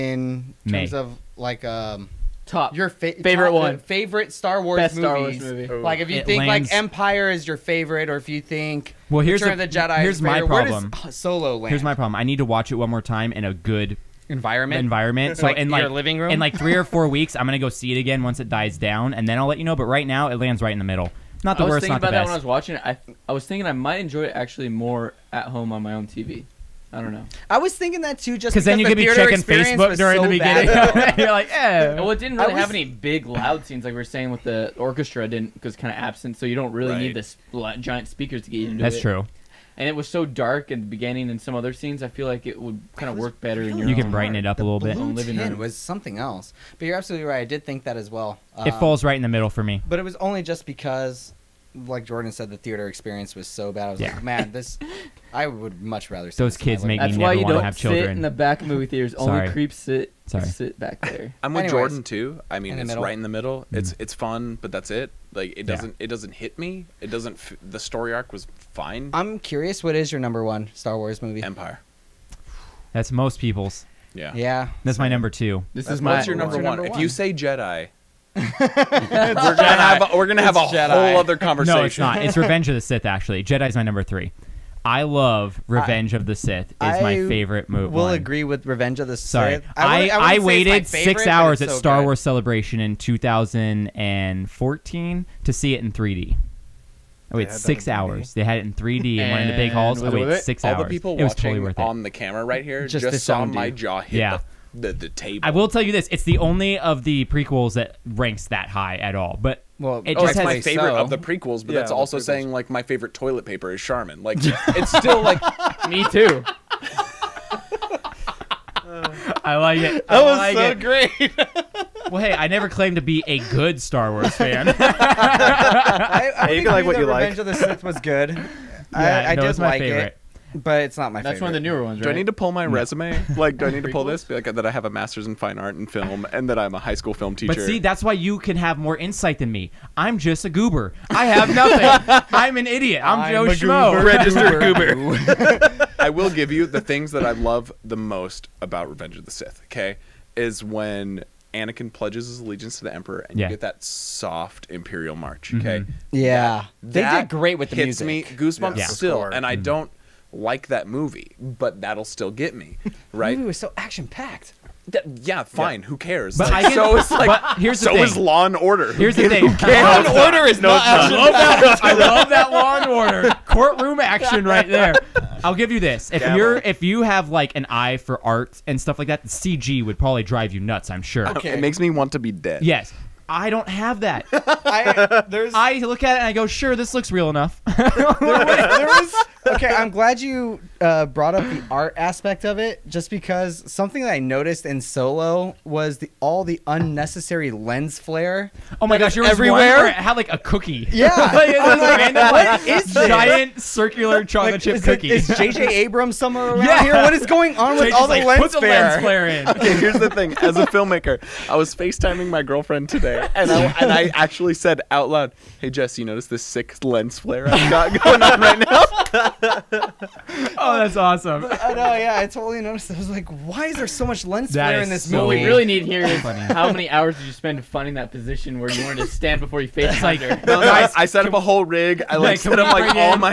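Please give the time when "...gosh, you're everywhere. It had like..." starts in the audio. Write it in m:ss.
3:18.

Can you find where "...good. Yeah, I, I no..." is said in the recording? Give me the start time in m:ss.
2:08.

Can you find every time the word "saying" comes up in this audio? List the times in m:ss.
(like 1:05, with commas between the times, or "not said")
0:34, 1:52.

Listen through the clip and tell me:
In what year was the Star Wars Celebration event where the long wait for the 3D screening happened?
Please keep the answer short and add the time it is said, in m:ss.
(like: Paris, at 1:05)
2014, at 1:32.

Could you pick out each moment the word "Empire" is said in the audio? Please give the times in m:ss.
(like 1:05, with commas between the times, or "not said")
0:06, 1:11.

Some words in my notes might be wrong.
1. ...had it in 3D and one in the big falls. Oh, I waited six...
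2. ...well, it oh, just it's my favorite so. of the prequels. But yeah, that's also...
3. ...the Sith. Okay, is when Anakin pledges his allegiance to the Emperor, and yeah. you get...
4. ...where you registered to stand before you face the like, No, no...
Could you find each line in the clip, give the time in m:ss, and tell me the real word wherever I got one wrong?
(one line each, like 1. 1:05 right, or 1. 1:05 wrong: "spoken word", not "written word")
1. 1:38 wrong: "halls", not "falls"
2. 1:49 right
3. 2:29 right
4. 3:48 wrong: "wanted", not "registered".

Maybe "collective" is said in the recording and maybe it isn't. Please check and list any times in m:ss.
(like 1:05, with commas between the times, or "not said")
not said.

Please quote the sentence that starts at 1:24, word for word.
I love Revenge I, of the Sith.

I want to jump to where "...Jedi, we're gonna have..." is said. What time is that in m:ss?
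1:17.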